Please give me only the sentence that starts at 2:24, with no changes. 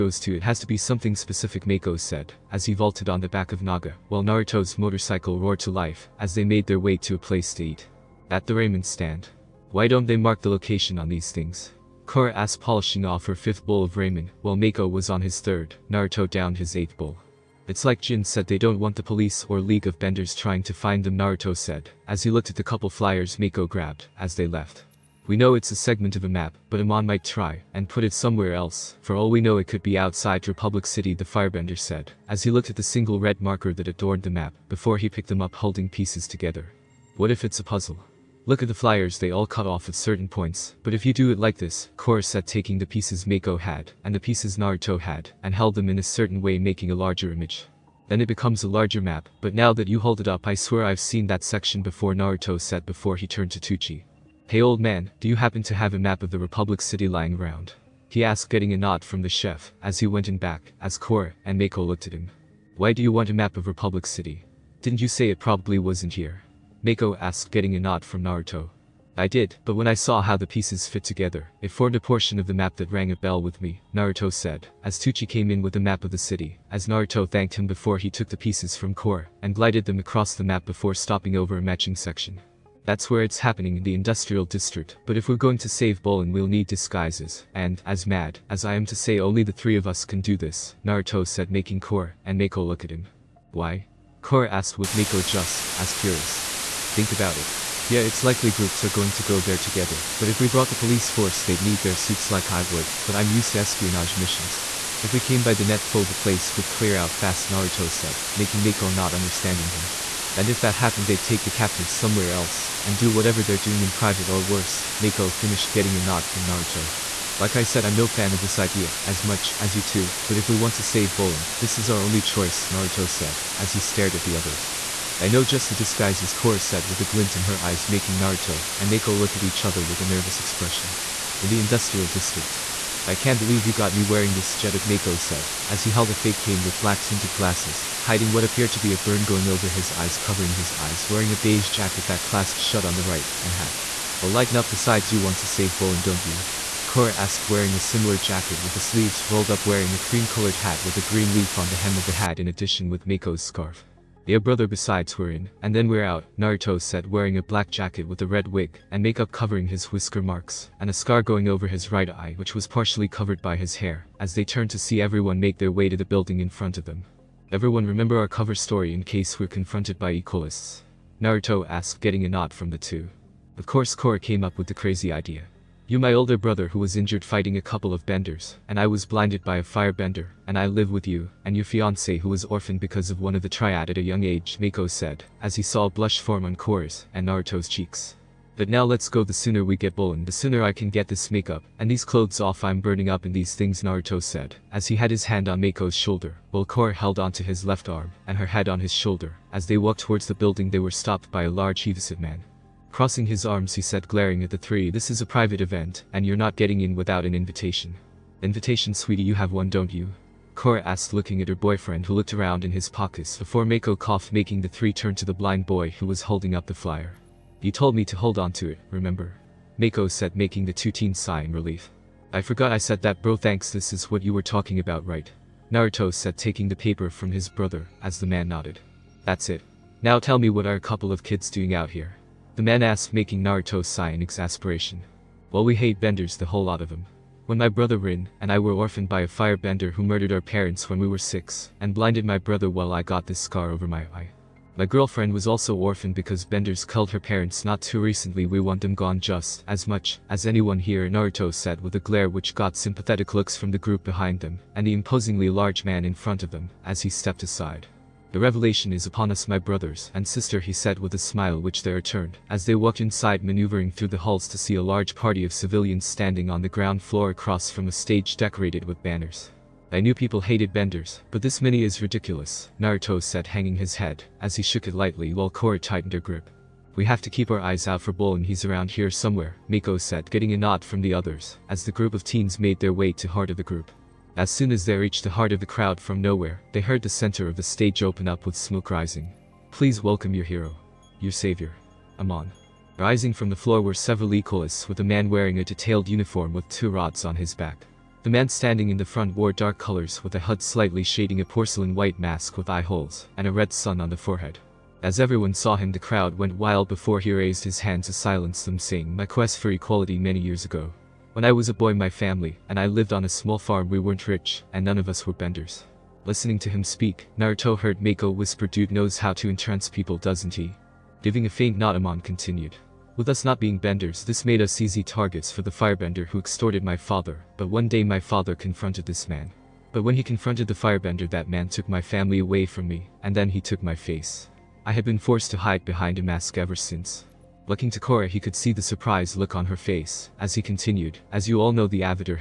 But lighten up besides you want to save Bolin don't you?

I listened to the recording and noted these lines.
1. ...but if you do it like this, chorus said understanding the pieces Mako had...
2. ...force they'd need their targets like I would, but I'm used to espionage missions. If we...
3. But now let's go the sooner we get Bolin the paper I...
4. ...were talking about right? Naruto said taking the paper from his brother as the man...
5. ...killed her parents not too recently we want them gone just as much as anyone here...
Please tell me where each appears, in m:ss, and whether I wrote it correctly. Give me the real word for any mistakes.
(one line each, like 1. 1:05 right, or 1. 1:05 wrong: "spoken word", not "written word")
1. 0:40 wrong: "taking", not "understanding"
2. 1:41 wrong: "suits", not "targets"
3. 3:08 wrong: "sooner", not "paper"
4. 3:44 right
5. 4:06 right.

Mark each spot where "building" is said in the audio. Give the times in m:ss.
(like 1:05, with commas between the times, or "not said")
2:46, 3:20.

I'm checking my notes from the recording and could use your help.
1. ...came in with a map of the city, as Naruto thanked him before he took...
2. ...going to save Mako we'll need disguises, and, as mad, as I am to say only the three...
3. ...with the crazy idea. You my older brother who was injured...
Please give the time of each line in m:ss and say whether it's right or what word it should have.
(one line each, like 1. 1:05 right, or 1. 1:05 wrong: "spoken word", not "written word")
1. 1:15 right
2. 1:25 wrong: "Bolin", not "Mako"
3. 2:54 right.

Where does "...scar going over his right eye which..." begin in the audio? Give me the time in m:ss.
2:40.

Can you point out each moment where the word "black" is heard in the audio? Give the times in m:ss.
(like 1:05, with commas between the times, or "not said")
2:16, 2:37.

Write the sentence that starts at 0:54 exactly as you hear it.
Hey old man, do you happen to have a map of the Republic City lying around?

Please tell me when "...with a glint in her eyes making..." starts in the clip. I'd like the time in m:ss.
2:06.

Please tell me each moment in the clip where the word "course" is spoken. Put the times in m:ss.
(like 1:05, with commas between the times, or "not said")
2:53.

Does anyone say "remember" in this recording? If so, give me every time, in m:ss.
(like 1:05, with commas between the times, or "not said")
2:47, 3:38.